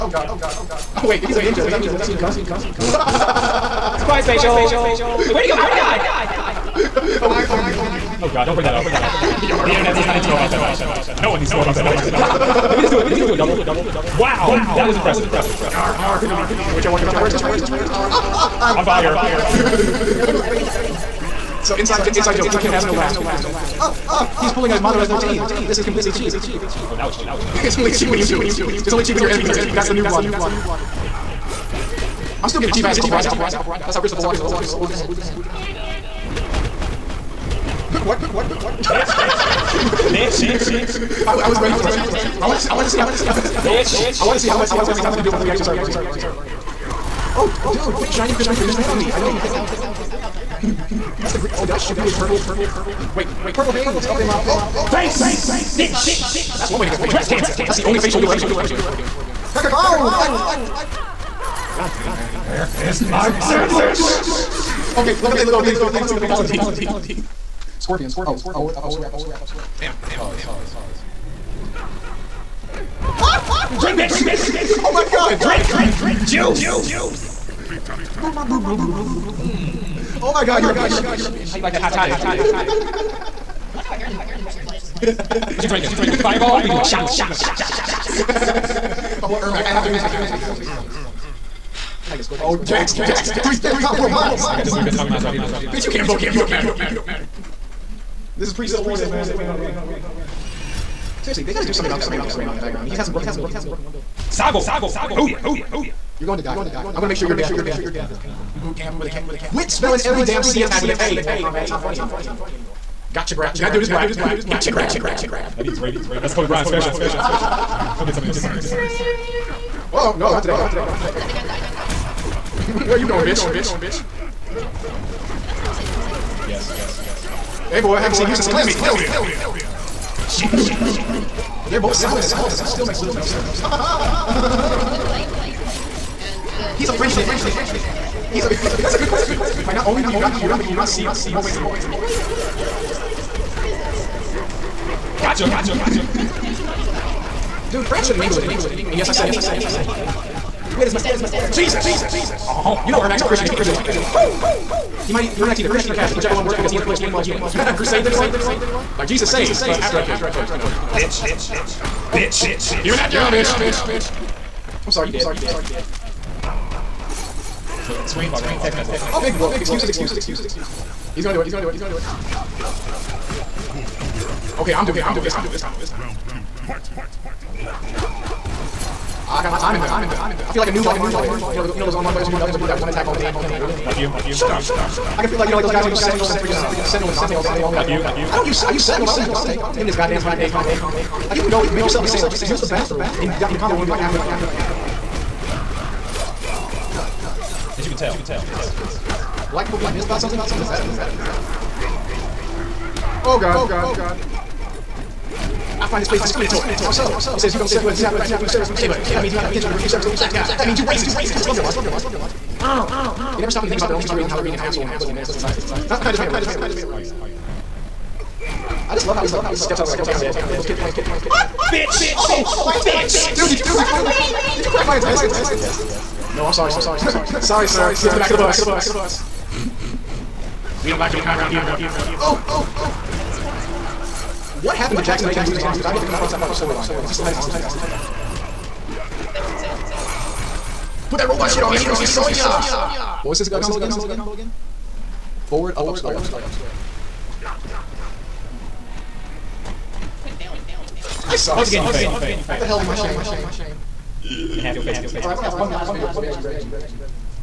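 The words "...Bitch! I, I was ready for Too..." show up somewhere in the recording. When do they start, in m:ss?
0:40.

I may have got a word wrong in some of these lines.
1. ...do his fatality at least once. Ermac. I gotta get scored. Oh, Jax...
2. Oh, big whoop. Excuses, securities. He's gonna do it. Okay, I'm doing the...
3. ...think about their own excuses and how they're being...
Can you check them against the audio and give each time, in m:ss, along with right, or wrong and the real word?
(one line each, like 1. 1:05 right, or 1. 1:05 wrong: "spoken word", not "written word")
1. 1:29 right
2. 2:48 wrong: "excuses", not "securities"
3. 3:33 wrong: "securities", not "excuses".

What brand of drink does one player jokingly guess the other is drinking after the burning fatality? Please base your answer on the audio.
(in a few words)
Fireball.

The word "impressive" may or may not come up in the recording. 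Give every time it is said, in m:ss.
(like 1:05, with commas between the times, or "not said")
0:14.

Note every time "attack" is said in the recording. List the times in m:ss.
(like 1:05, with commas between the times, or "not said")
1:50, 3:02.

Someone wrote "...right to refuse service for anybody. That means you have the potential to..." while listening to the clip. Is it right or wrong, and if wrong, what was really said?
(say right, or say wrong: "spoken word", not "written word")
right.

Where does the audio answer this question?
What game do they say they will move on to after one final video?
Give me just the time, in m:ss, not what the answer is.
4:16.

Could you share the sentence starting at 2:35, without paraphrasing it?
He might, Ermac's either Christian or Catholic, whichever one works because he inflicts pain while healing.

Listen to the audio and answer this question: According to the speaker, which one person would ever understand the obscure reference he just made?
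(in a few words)
Corey.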